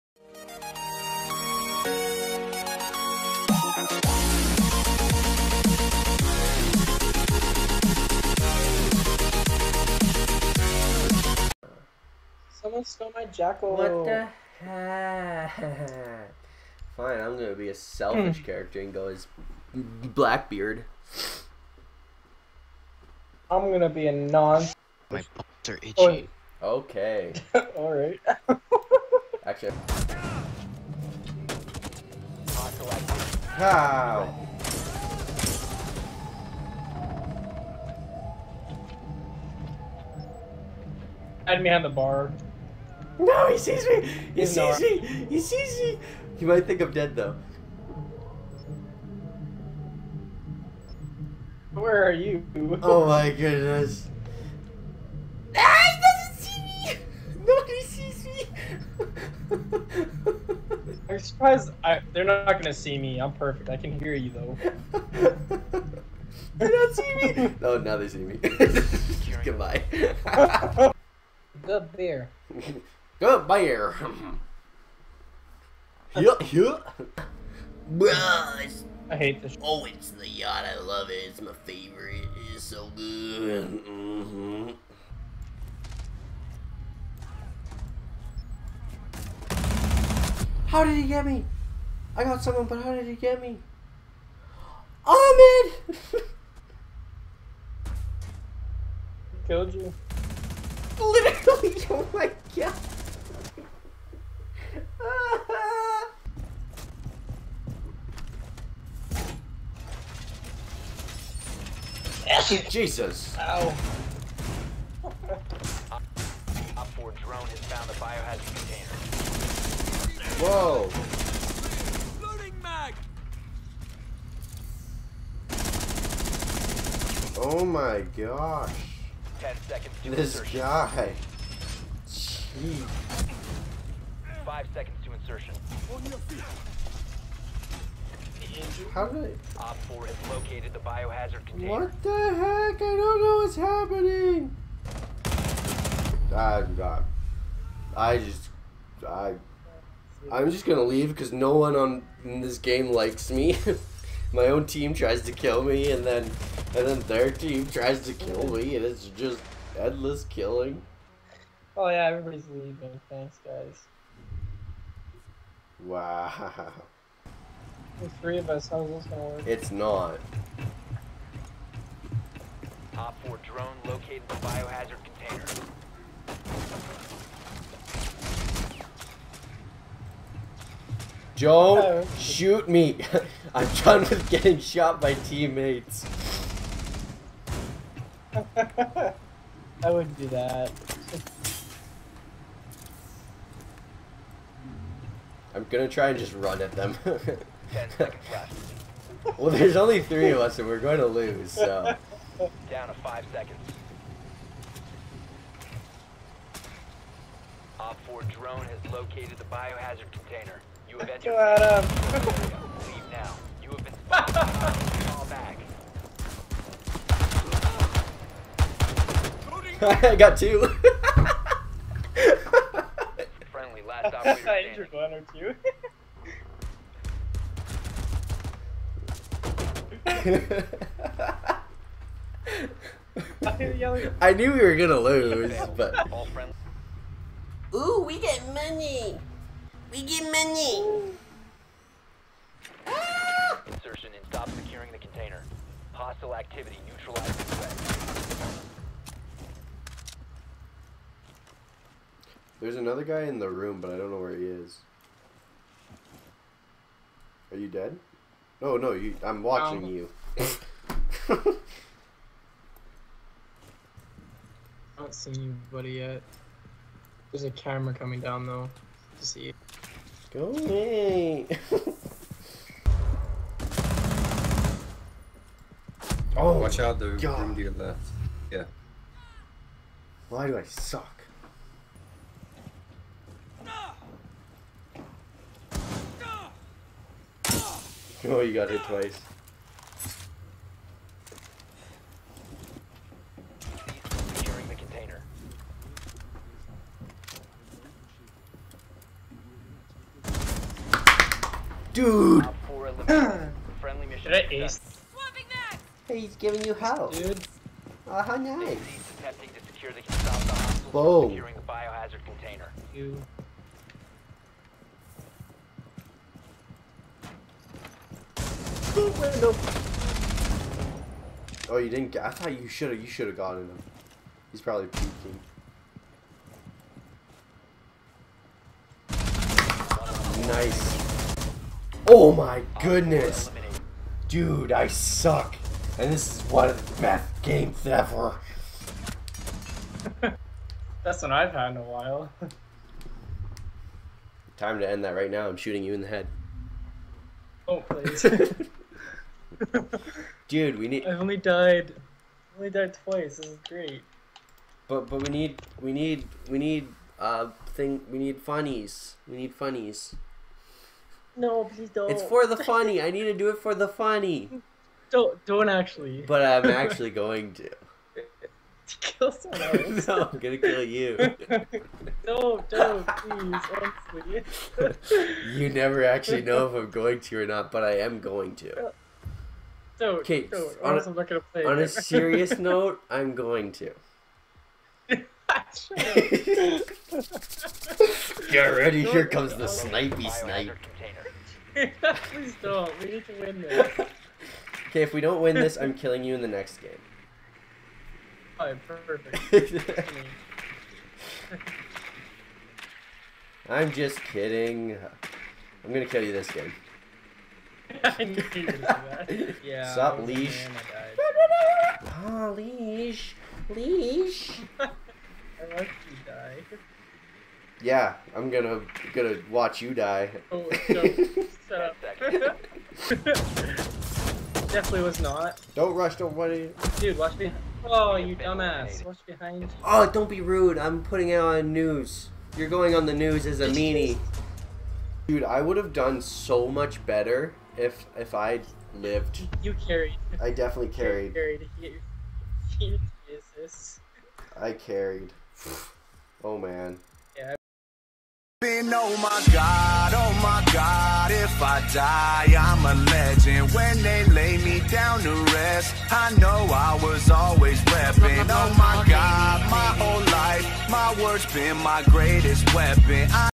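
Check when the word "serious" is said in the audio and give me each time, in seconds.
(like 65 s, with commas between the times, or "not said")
381 s.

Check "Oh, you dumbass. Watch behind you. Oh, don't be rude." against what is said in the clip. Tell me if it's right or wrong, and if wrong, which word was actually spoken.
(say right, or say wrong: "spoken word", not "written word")
right.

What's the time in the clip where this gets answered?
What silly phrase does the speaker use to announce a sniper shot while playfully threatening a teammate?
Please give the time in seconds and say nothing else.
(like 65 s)
389 s.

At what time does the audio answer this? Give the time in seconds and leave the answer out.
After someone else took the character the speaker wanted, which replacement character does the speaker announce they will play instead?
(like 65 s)
19 s.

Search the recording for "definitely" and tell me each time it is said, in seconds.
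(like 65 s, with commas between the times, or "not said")
424 s, 440 s.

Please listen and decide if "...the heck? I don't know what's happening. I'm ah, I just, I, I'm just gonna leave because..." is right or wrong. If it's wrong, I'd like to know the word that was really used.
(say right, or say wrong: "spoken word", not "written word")
right.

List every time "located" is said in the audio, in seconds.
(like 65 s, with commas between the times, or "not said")
140 s, 173 s, 208 s.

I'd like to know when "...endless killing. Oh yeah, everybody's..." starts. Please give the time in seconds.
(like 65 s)
159 s.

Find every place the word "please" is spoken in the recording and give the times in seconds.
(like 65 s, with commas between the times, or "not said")
347 s, 361 s, 373 s, 391 s.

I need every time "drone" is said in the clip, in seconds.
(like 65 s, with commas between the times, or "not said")
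173 s, 208 s.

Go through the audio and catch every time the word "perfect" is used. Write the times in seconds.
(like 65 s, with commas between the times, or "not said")
63 s, 398 s.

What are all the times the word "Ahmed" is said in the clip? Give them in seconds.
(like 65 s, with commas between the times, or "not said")
95 s.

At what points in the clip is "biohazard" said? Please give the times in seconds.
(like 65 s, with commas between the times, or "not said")
140 s, 174 s, 209 s, 311 s.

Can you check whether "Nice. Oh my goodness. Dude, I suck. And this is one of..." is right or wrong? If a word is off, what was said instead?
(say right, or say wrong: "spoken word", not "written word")
right.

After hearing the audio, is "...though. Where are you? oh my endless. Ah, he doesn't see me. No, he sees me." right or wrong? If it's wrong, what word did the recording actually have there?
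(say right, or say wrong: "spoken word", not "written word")
wrong: "goodness", not "endless".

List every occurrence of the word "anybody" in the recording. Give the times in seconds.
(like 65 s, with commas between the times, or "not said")
265 s.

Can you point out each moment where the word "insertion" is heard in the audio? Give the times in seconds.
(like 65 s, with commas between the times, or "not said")
130 s, 135 s, 243 s.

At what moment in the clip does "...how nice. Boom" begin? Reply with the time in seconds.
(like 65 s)
308 s.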